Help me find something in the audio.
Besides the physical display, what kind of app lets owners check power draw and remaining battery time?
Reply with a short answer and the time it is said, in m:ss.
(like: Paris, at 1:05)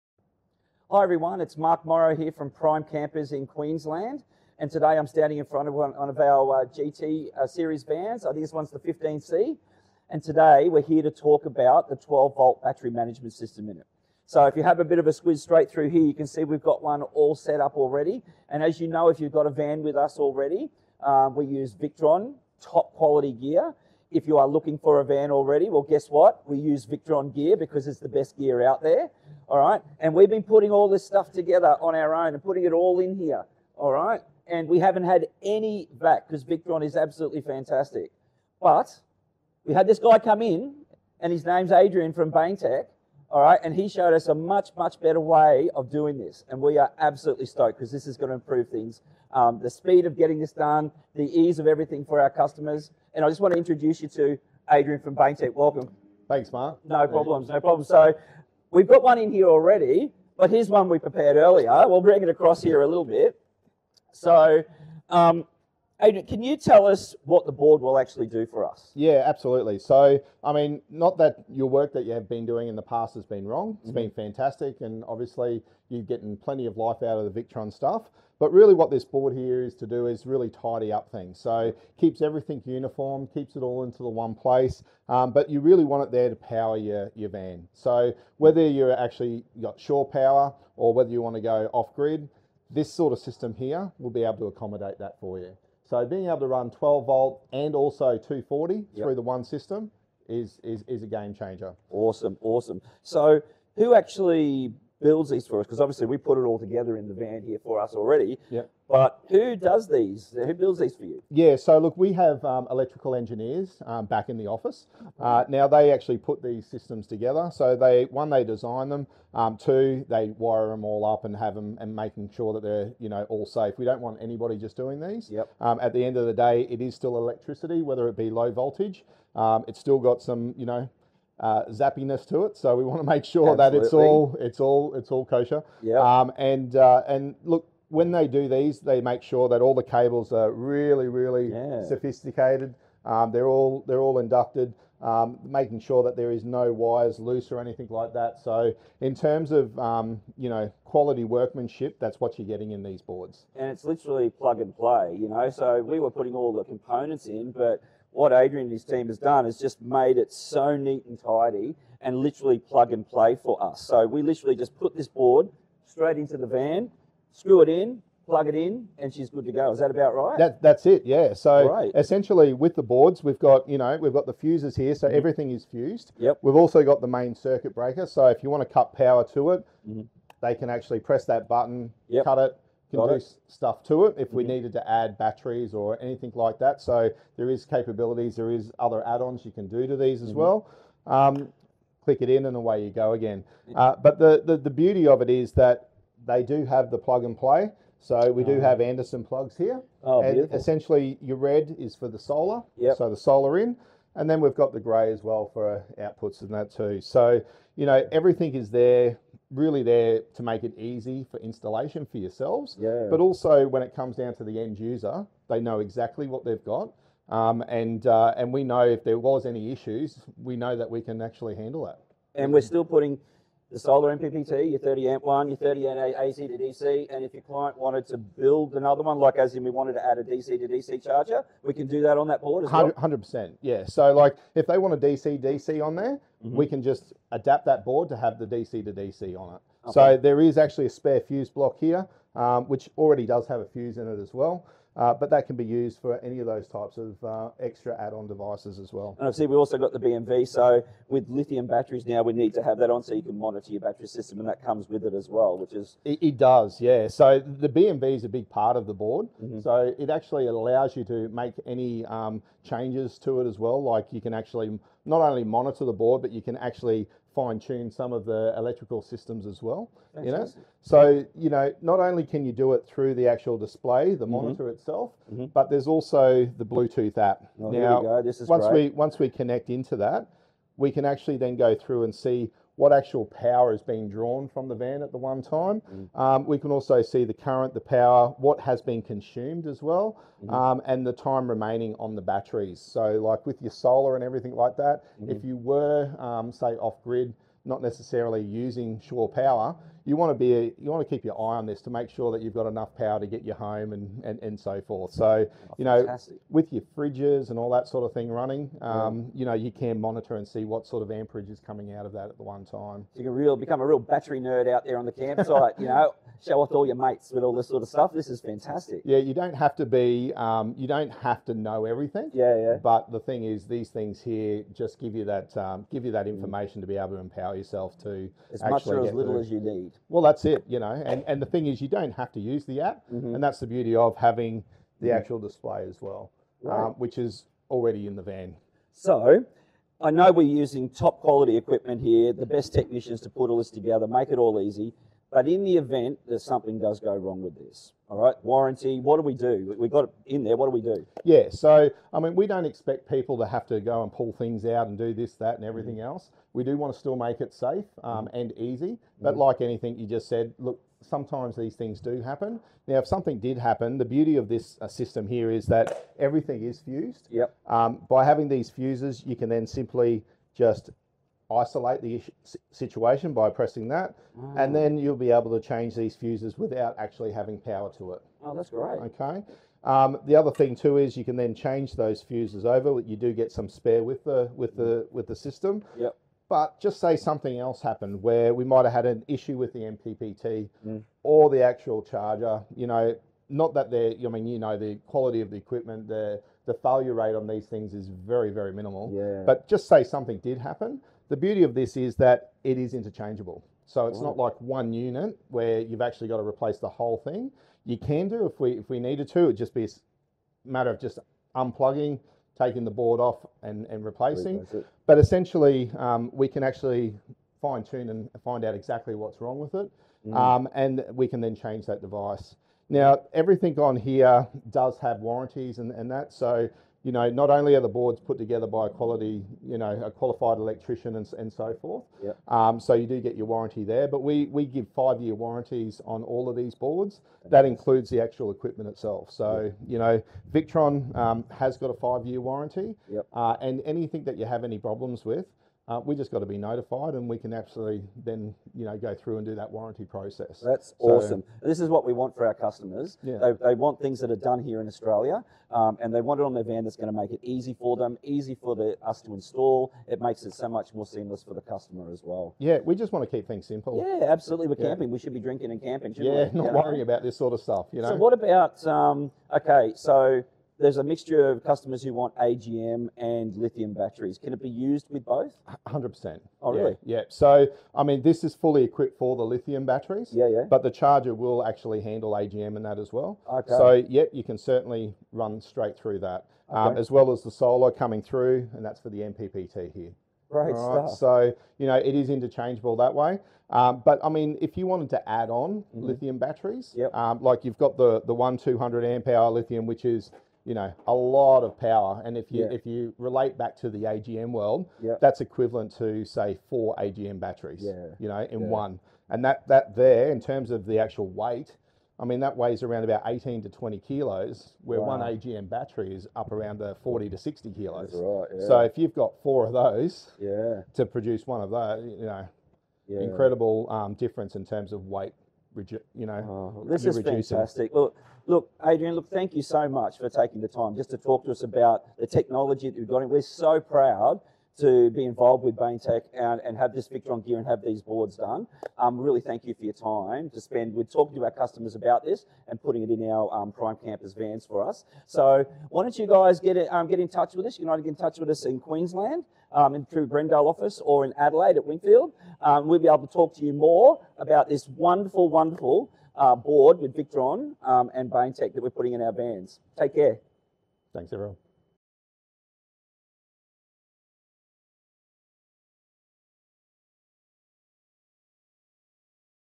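Bluetooth app, at 4:36.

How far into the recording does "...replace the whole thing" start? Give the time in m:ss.
6:46.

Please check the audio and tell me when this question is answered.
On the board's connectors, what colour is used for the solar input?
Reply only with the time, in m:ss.
3:21.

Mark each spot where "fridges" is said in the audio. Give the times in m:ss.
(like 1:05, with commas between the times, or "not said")
5:06.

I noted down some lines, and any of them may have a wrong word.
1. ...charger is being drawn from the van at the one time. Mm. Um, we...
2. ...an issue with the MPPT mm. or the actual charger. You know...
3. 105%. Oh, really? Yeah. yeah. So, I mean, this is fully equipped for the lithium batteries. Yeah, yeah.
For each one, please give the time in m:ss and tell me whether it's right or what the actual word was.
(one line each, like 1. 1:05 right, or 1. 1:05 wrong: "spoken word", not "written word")
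1. 4:43 wrong: "power", not "charger"
2. 6:29 right
3. 7:55 wrong: "100", not "105".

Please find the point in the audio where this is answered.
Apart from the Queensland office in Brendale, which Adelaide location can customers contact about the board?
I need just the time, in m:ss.
9:11.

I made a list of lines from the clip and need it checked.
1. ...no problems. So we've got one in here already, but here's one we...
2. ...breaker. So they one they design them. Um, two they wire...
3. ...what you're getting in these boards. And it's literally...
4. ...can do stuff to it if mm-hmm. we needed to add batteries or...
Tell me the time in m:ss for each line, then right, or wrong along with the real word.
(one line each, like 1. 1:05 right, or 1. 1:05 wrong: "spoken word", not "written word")
1. 0:57 right
2. 1:57 wrong: "together", not "breaker"
3. 2:32 right
4. 3:02 right.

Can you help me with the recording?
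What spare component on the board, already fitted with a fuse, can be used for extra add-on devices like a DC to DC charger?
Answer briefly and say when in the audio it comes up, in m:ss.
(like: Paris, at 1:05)
fuse block, at 4:01.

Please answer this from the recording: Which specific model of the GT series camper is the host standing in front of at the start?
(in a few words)
15C.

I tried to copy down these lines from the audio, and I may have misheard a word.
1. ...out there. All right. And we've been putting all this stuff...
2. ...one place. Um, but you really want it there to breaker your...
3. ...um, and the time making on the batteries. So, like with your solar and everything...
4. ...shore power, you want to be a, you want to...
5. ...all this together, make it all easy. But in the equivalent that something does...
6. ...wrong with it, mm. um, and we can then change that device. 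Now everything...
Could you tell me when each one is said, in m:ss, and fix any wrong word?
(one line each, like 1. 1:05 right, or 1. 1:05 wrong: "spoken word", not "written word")
1. 0:28 right
2. 1:24 wrong: "power", not "breaker"
3. 4:50 wrong: "remaining", not "making"
4. 4:58 right
5. 5:43 wrong: "event", not "equivalent"
6. 6:59 right.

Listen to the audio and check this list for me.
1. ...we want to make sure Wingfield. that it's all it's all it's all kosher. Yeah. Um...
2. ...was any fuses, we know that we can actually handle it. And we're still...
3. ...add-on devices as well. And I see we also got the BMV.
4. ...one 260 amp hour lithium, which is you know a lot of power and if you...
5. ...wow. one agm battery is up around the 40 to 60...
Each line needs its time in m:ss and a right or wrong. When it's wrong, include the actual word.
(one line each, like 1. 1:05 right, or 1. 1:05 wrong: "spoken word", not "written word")
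1. 2:12 wrong: "Absolutely", not "Wingfield"
2. 3:39 wrong: "issues", not "fuses"
3. 4:08 right
4. 8:18 wrong: "200", not "260"
5. 8:35 right.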